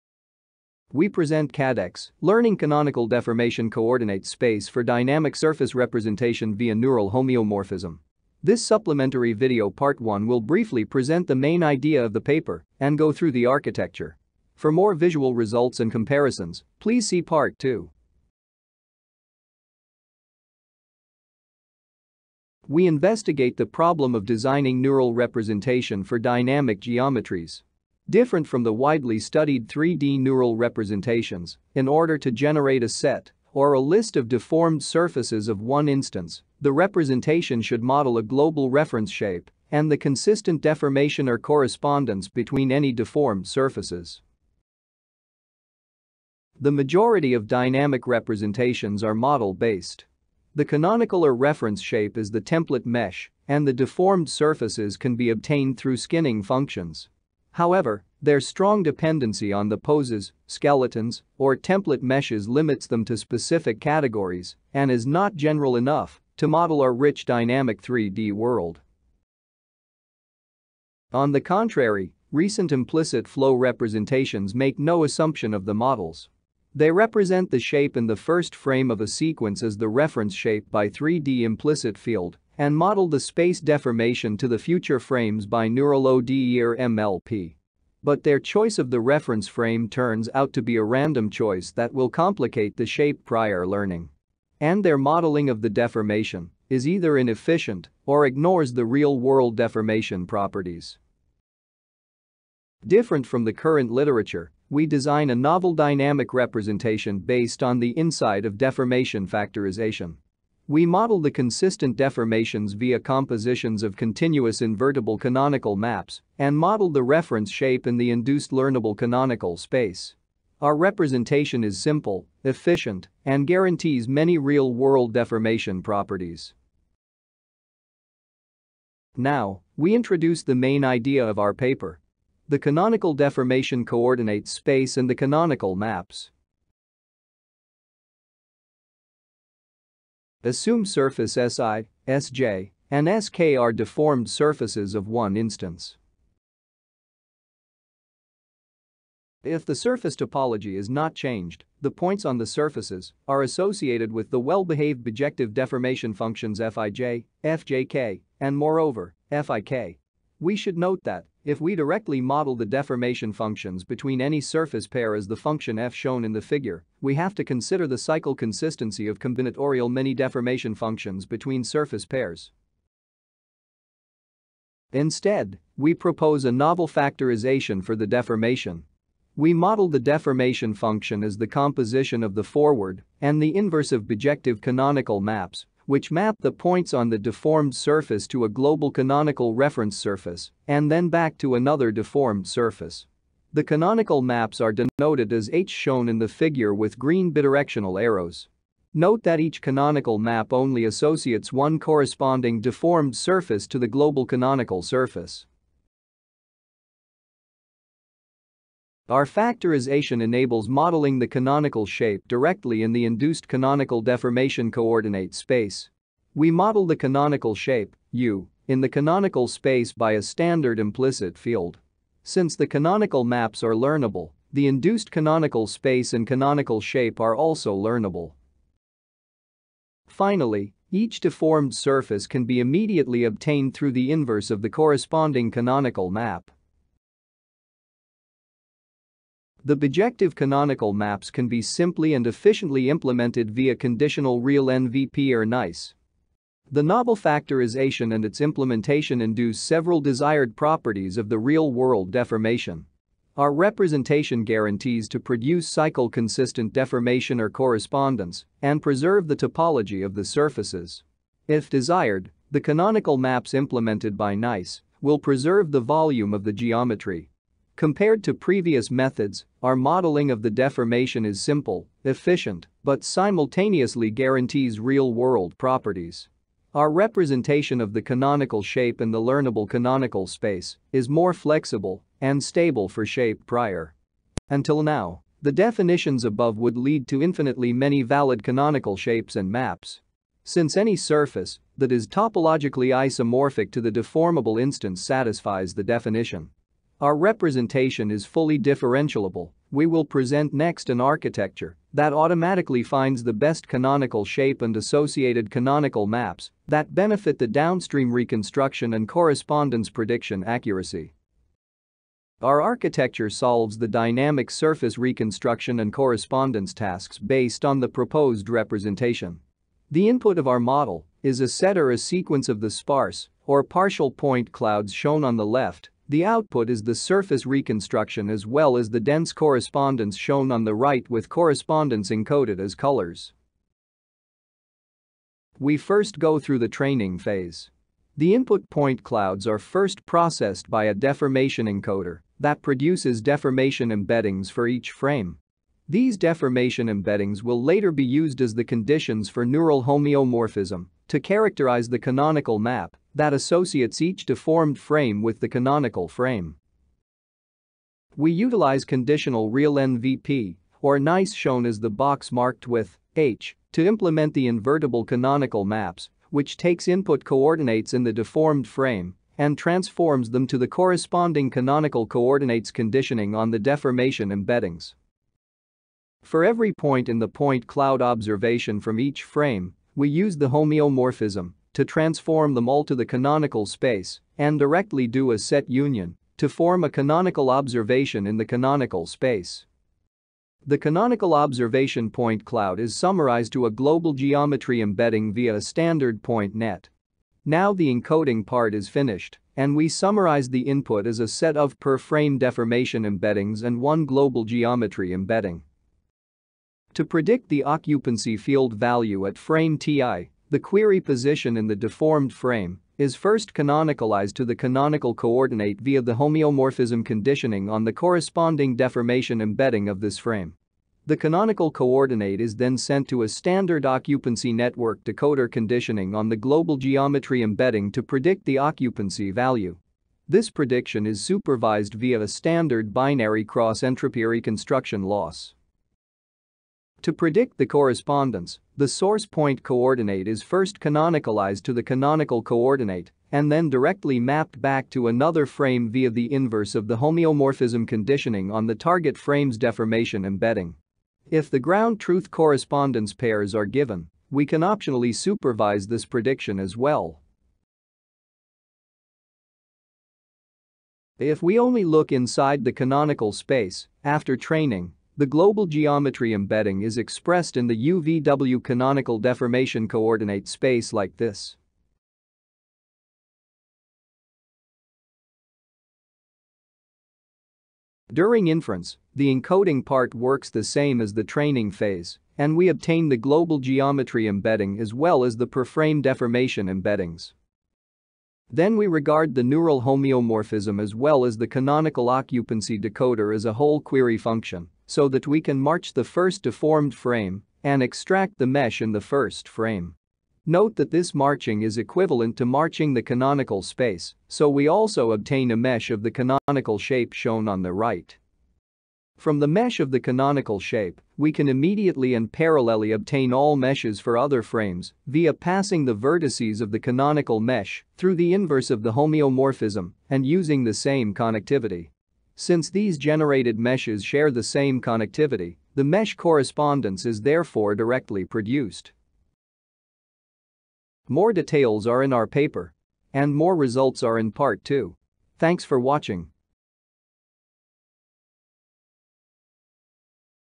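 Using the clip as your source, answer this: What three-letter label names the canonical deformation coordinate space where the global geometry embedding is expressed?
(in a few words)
UVW.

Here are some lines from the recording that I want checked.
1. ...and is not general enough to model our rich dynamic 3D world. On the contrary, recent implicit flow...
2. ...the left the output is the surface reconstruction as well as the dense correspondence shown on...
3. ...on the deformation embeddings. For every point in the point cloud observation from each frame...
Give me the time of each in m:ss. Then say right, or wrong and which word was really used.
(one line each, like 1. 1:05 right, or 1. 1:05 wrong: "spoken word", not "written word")
1. 1:04 right
2. 5:25 right
3. 6:13 right.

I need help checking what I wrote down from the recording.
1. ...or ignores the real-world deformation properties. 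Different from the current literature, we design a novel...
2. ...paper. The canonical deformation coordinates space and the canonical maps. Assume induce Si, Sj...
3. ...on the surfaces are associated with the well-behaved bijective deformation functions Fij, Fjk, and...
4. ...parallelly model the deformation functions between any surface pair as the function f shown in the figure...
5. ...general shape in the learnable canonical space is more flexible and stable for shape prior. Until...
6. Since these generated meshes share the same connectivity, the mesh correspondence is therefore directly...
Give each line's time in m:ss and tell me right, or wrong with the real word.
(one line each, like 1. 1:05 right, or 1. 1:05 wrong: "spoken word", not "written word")
1. 1:38 right
2. 2:11 wrong: "surface", not "induce"
3. 2:32 right
4. 2:41 wrong: "directly", not "parallelly"
5. 4:38 wrong: "canonical", not "general"
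6. 8:42 right.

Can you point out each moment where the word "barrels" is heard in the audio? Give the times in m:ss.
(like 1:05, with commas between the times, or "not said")
not said.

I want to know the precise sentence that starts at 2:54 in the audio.
Instead, we propose a novel factorization for the deformation.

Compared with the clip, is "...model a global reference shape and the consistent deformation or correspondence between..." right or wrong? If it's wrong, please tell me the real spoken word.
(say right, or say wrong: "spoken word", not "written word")
right.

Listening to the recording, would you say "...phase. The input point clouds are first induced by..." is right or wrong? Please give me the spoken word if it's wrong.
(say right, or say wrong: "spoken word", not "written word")
wrong: "processed", not "induced".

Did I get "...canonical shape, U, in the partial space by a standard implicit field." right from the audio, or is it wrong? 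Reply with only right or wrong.
wrong.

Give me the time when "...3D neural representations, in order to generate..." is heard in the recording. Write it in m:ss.
0:29.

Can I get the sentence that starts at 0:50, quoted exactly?
The canonical or reference shape is the template mesh, and the deformed surfaces can be obtained through skinning functions.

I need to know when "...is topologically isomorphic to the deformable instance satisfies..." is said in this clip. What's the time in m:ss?
4:51.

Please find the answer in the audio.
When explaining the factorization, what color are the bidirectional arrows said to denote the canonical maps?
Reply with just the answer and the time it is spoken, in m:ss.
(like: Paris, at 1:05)
Green, at 3:16.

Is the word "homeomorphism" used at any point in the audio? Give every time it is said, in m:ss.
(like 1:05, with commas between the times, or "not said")
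0:07, 5:49, 6:20, 6:56, 7:26, 8:09, 8:38.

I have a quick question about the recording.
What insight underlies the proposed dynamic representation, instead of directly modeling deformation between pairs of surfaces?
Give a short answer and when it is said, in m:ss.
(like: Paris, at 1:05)
Deformation factorization, at 1:48.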